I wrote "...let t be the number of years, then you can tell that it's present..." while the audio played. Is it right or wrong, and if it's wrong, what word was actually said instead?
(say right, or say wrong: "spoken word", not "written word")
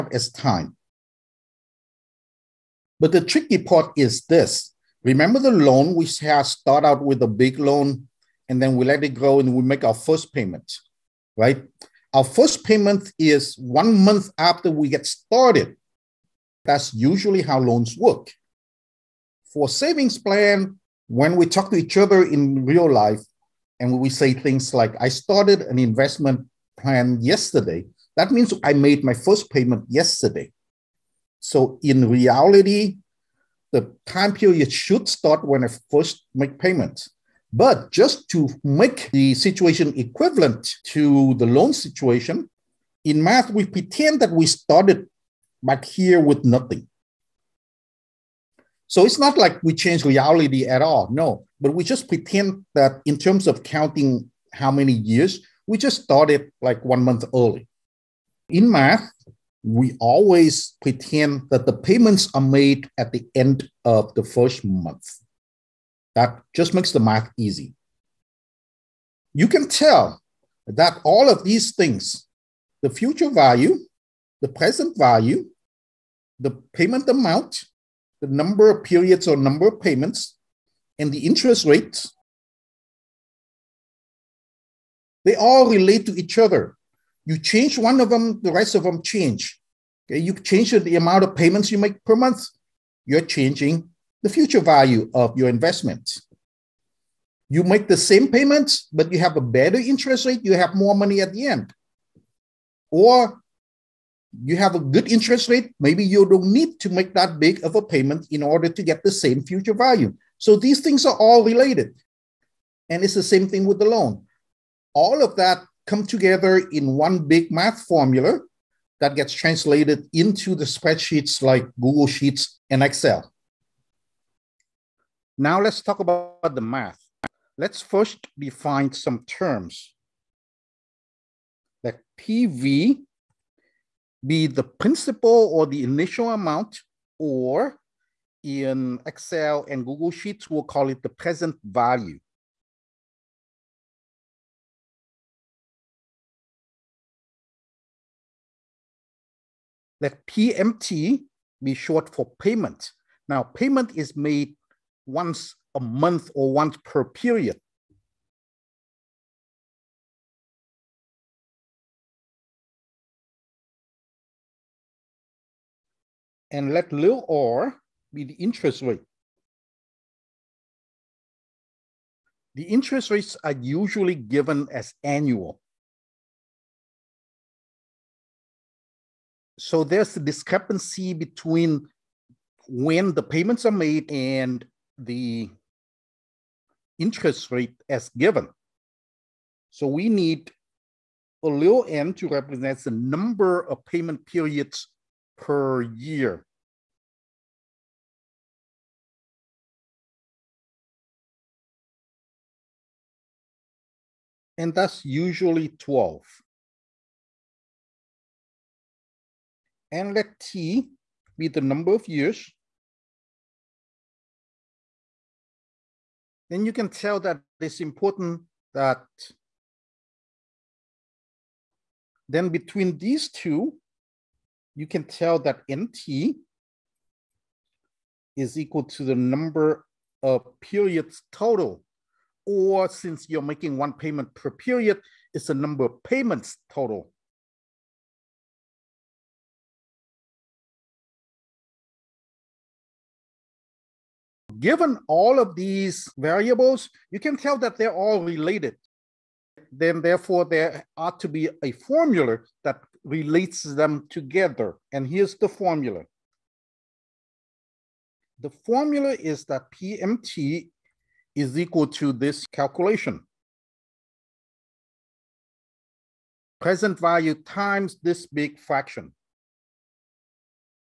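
wrong: "important", not "present".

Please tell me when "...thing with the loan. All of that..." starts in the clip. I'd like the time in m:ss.
1:53.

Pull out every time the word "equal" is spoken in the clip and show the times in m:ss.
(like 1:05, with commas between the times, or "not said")
3:48, 4:21.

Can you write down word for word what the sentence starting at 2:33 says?
Now, payment is made once a month or once per period.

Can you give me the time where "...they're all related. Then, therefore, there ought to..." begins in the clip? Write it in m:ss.
4:07.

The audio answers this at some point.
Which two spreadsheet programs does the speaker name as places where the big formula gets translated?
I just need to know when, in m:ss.
2:01.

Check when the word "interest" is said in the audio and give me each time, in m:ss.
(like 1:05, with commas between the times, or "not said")
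1:21, 1:39, 1:45, 2:48, 2:52, 3:06.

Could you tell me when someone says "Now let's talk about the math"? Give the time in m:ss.
2:05.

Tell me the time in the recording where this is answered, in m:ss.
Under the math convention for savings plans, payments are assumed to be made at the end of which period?
1:04.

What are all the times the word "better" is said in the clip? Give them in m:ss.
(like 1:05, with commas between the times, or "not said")
1:39.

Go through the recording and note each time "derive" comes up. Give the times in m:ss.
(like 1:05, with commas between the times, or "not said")
not said.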